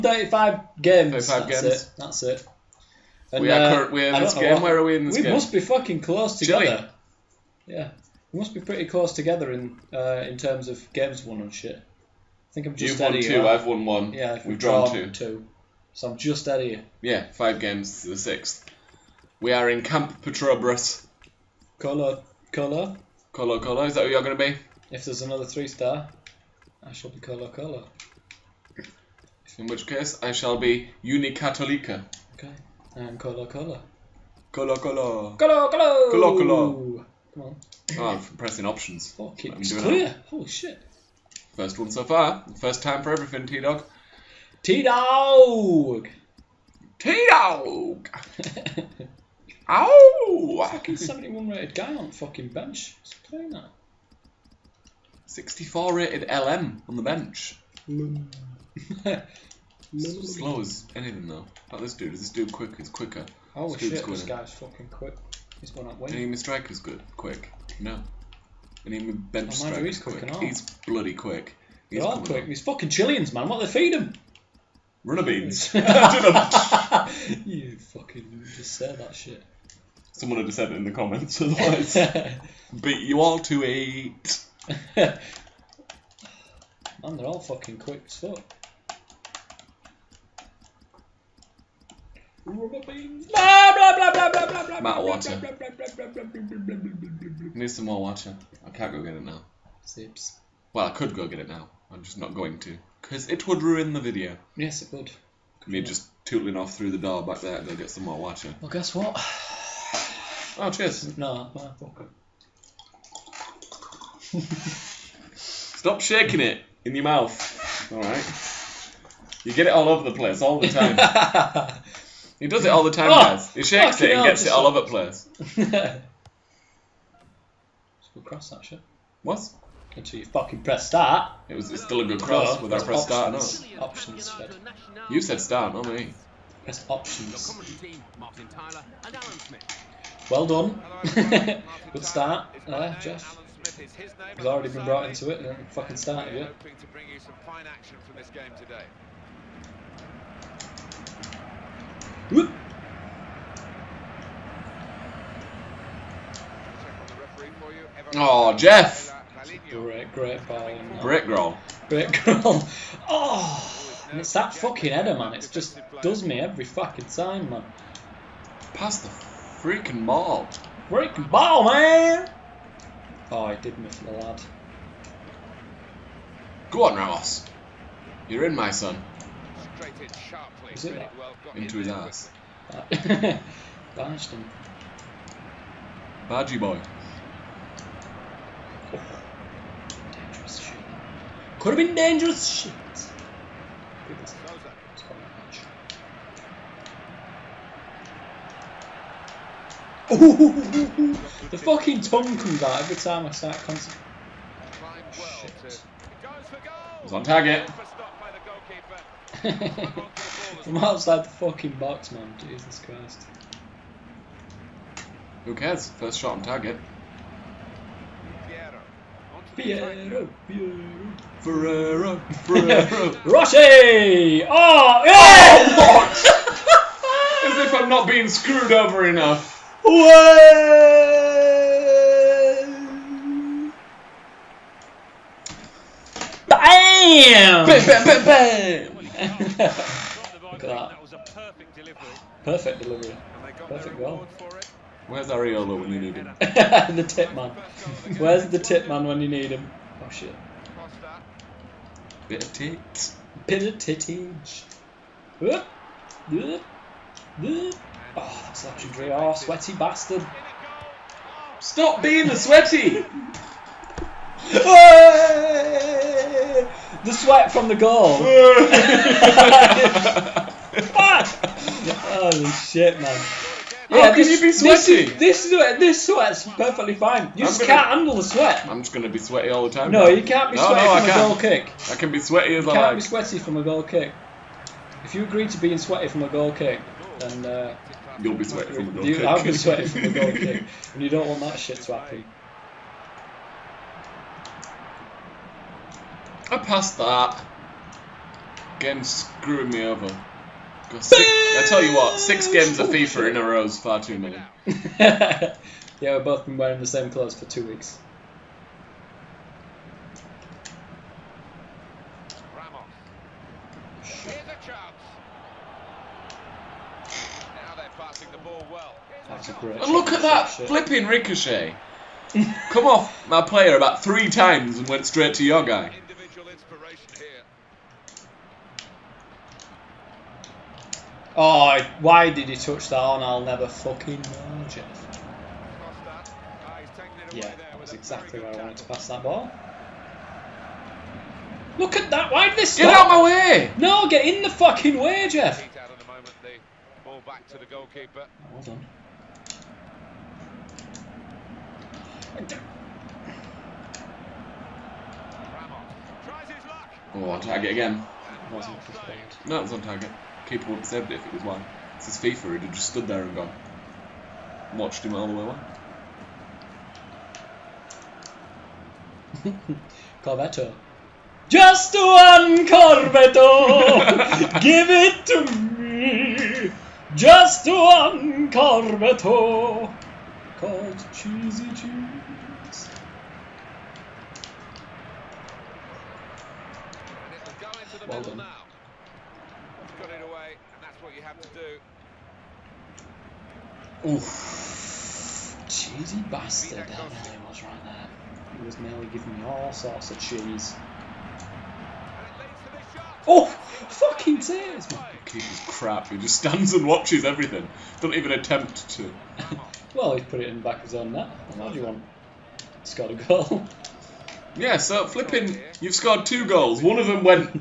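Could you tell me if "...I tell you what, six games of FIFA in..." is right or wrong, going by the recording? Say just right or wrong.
right.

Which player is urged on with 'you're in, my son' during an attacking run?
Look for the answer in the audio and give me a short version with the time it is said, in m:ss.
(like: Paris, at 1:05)
Ramos, at 2:56.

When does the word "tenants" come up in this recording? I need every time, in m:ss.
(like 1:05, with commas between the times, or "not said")
not said.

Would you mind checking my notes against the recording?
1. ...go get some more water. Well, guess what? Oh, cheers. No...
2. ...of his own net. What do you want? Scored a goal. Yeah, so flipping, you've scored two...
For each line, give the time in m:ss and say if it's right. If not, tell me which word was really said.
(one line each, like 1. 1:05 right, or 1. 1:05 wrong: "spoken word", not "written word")
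1. 1:47 right
2. 6:50 right.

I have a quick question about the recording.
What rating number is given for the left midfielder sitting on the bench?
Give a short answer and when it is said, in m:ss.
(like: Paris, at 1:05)
64, at 0:55.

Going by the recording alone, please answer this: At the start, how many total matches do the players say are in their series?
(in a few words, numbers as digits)
35.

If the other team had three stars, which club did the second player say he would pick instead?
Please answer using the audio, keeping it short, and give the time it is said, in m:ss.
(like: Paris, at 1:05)
Unicatolica, at 0:31.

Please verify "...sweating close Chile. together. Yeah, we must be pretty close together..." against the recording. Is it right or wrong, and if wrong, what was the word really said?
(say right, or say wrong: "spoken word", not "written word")
wrong: "fucking", not "sweating".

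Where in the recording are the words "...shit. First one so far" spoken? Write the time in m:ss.
0:40.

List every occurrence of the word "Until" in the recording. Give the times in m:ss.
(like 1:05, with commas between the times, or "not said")
2:09.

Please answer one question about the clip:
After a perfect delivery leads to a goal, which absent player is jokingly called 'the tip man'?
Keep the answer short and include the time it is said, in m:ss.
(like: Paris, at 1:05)
Ariola, at 4:05.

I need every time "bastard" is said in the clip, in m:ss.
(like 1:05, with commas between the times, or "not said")
4:19, 6:36.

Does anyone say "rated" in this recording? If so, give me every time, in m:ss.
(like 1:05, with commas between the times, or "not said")
0:51, 0:55.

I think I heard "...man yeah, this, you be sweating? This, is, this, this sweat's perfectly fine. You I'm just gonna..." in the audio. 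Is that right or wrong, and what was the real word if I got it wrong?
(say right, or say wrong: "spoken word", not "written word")
right.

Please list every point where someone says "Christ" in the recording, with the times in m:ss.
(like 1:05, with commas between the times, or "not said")
3:32.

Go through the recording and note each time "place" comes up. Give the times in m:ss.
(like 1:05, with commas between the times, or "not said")
2:00, 2:04.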